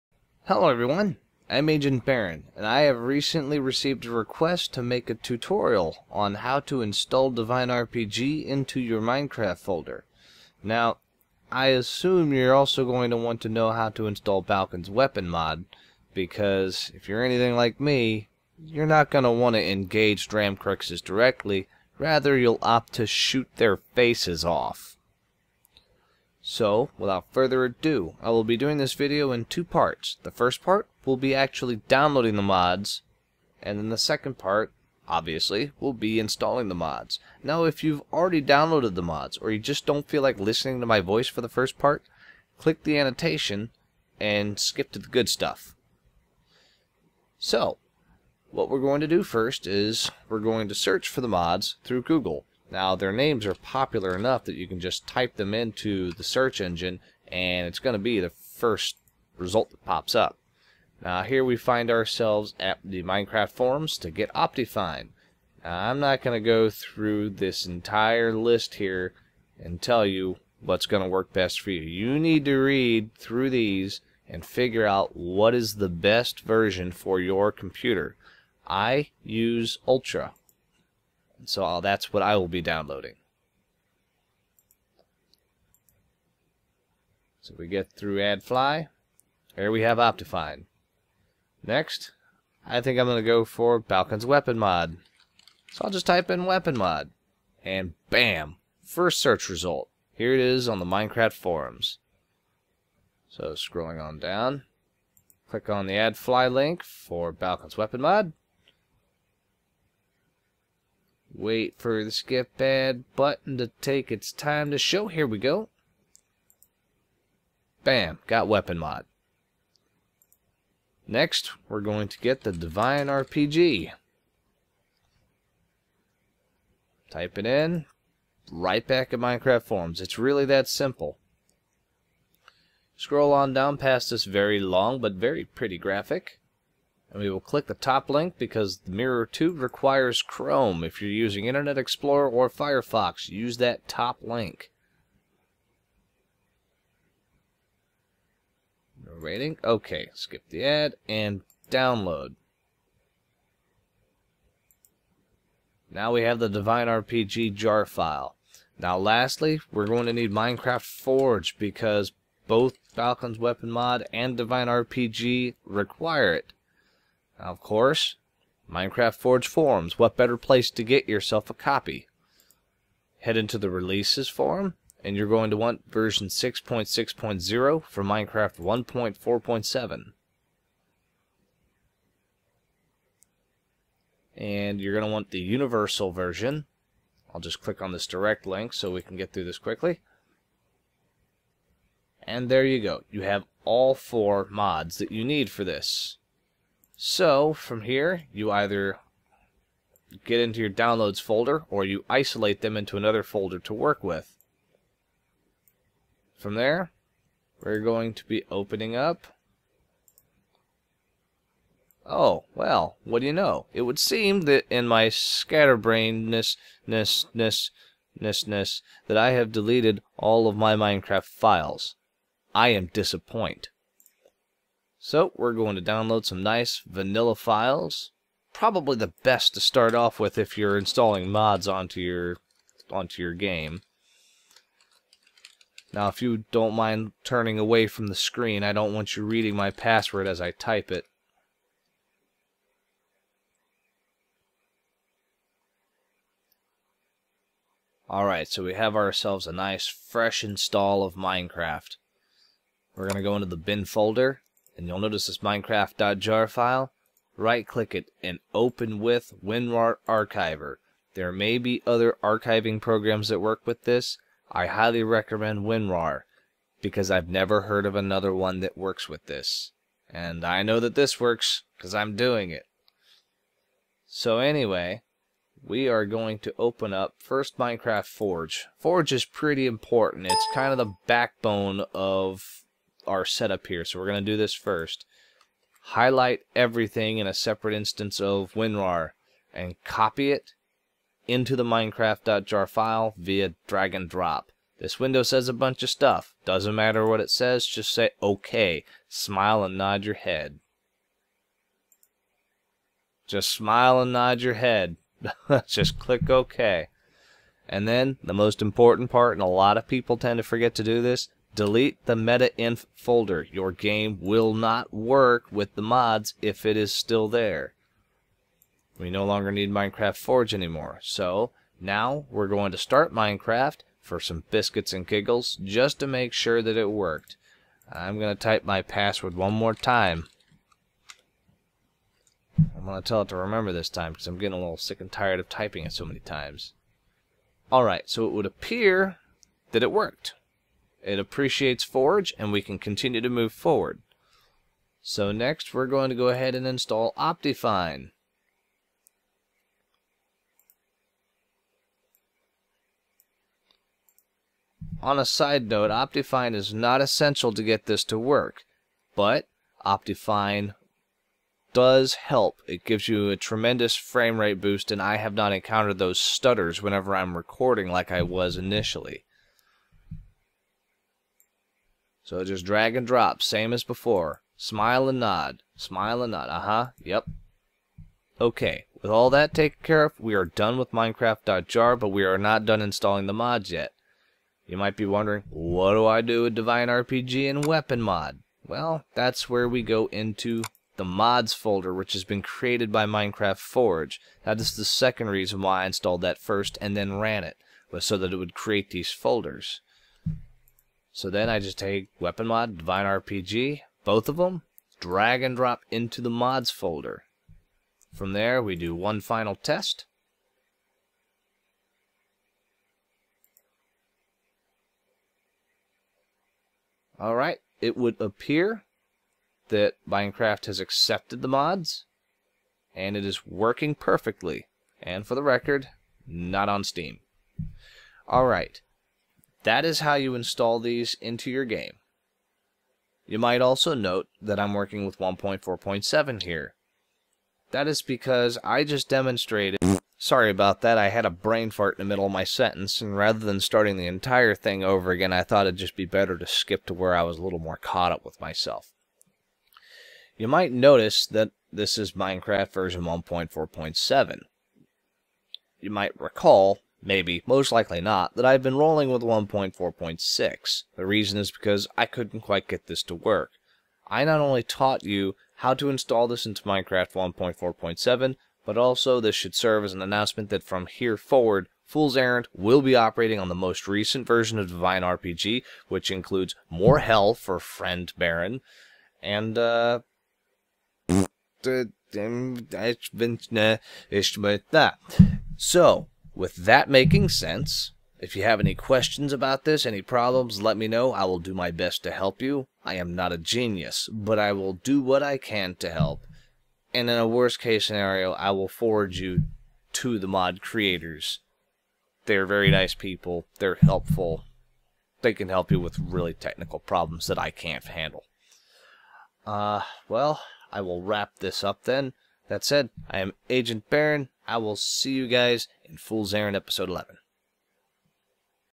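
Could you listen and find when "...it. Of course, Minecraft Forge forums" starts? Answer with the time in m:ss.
2:46.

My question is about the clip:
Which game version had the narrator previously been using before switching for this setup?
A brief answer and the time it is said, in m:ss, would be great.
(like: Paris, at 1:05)
1.4.6, at 7:39.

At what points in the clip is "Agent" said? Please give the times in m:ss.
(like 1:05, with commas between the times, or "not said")
0:01, 8:33.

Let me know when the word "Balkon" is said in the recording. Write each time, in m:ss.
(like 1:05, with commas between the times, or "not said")
0:14, 1:33, 1:47, 2:42.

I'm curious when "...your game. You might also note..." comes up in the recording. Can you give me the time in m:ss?
7:11.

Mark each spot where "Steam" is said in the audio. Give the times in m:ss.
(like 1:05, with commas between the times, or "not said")
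7:06.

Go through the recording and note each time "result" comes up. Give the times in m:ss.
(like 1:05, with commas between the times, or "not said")
0:59, 1:39.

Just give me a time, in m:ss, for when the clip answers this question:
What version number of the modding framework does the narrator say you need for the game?
2:56.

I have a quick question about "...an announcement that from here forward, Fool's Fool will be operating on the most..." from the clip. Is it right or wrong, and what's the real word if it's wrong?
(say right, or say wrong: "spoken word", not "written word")
wrong: "Errand", not "Fool".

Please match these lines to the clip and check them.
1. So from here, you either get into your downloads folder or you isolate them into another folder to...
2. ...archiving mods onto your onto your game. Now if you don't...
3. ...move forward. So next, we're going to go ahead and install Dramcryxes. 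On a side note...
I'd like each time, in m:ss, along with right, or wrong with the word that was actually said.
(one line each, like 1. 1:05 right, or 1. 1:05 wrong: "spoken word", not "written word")
1. 3:17 right
2. 3:50 wrong: "installing", not "archiving"
3. 5:43 wrong: "Optifine", not "Dramcryxes".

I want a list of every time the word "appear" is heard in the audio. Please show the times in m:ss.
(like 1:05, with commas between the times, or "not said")
5:38, 6:58.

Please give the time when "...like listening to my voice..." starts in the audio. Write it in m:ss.
0:40.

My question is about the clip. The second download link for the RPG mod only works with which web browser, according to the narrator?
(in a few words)
Chrome.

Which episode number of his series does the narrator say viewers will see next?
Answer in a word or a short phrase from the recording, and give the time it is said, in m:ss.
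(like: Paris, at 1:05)
11, at 8:36.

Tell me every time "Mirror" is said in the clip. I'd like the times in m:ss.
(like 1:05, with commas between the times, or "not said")
2:18.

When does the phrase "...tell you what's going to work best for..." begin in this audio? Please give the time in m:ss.
1:09.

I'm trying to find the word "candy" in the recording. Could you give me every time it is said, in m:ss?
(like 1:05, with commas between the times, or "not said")
not said.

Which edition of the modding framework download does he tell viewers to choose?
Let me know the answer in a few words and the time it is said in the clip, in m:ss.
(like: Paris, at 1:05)
universal, at 3:05.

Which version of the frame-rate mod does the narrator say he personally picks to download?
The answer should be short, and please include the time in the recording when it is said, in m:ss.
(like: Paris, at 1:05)
Ultra, at 1:19.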